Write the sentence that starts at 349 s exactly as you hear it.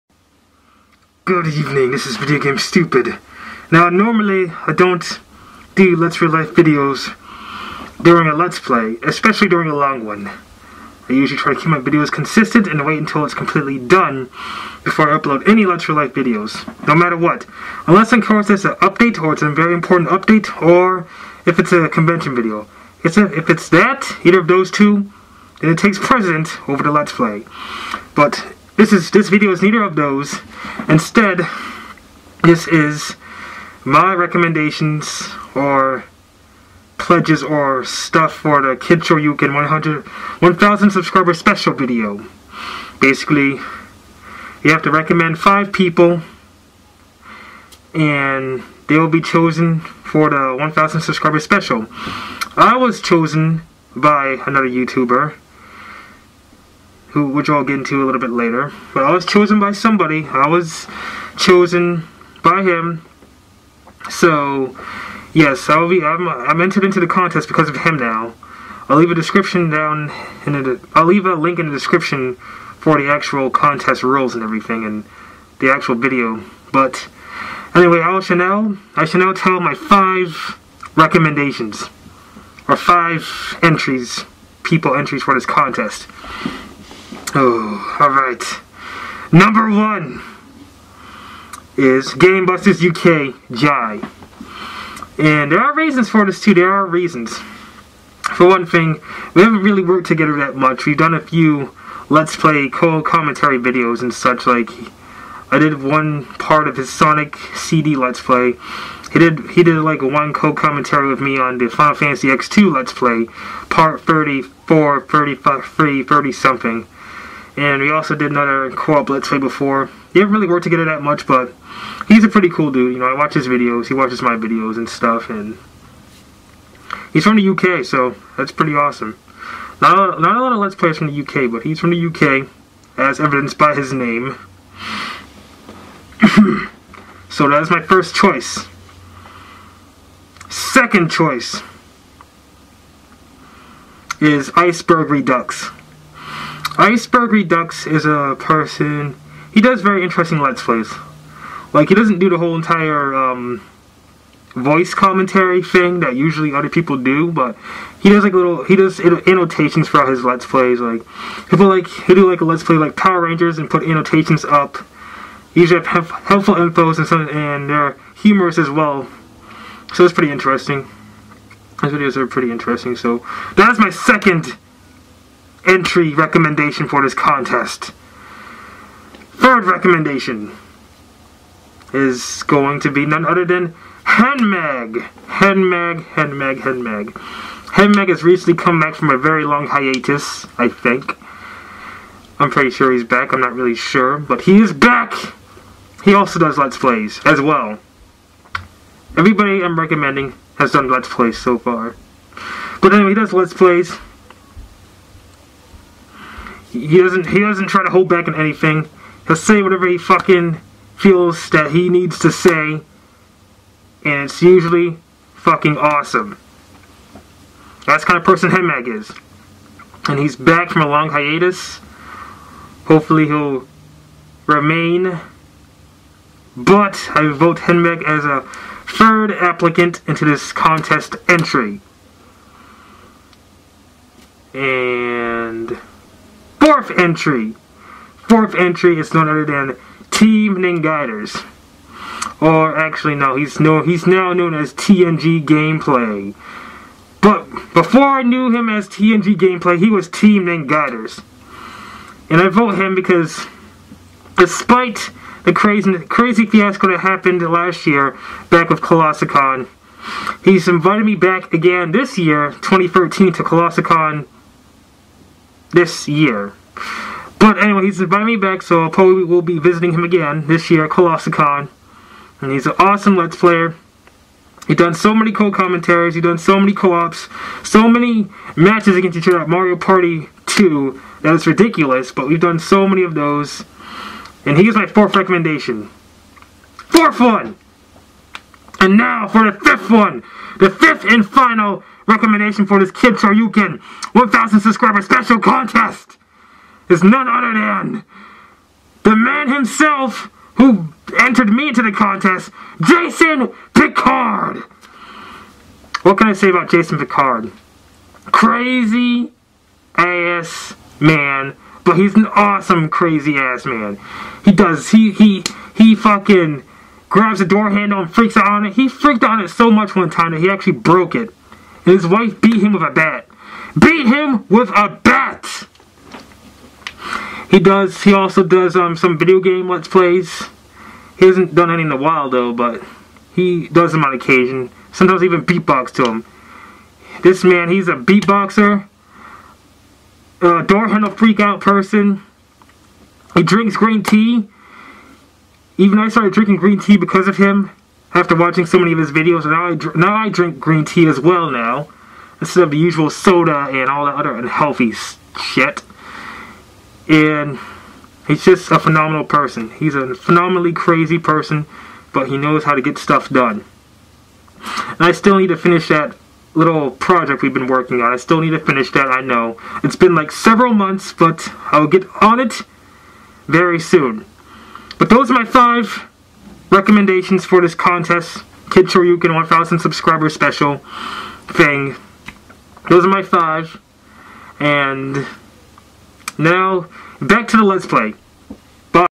Now I, now I drink green tea as well now instead of the usual soda and all that other unhealthy shit.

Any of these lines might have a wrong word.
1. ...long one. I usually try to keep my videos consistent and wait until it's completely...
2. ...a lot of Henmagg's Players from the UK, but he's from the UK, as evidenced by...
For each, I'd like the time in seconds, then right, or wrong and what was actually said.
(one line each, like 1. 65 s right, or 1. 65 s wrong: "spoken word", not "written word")
1. 9 s right
2. 130 s wrong: "Let", not "Henmagg".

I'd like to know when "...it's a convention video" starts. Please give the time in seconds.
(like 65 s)
21 s.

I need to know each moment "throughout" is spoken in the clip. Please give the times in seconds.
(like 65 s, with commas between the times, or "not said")
159 s.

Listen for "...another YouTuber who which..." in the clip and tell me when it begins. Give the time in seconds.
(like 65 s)
54 s.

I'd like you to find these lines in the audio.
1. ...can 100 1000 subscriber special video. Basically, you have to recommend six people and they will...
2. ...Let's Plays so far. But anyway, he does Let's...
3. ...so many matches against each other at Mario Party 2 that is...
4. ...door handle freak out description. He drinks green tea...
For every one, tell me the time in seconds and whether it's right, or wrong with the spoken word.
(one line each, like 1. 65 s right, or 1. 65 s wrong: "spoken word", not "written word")
1. 39 s wrong: "five", not "six"
2. 200 s right
3. 277 s right
4. 340 s wrong: "person", not "description".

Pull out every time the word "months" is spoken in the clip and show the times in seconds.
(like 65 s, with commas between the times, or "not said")
370 s.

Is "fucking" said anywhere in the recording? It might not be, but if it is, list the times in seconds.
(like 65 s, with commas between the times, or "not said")
209 s, 215 s, 315 s.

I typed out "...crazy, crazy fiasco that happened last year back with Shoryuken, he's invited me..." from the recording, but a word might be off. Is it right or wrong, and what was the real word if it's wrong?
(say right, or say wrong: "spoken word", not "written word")
wrong: "Colossalcon", not "Shoryuken".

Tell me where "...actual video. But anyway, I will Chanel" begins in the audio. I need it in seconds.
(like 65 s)
75 s.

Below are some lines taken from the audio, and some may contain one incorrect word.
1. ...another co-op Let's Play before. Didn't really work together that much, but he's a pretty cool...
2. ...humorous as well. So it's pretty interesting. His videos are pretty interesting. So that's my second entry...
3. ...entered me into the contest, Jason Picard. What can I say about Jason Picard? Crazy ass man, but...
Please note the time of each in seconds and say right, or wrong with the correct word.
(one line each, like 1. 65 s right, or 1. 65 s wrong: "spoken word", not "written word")
1. 118 s right
2. 168 s right
3. 301 s right.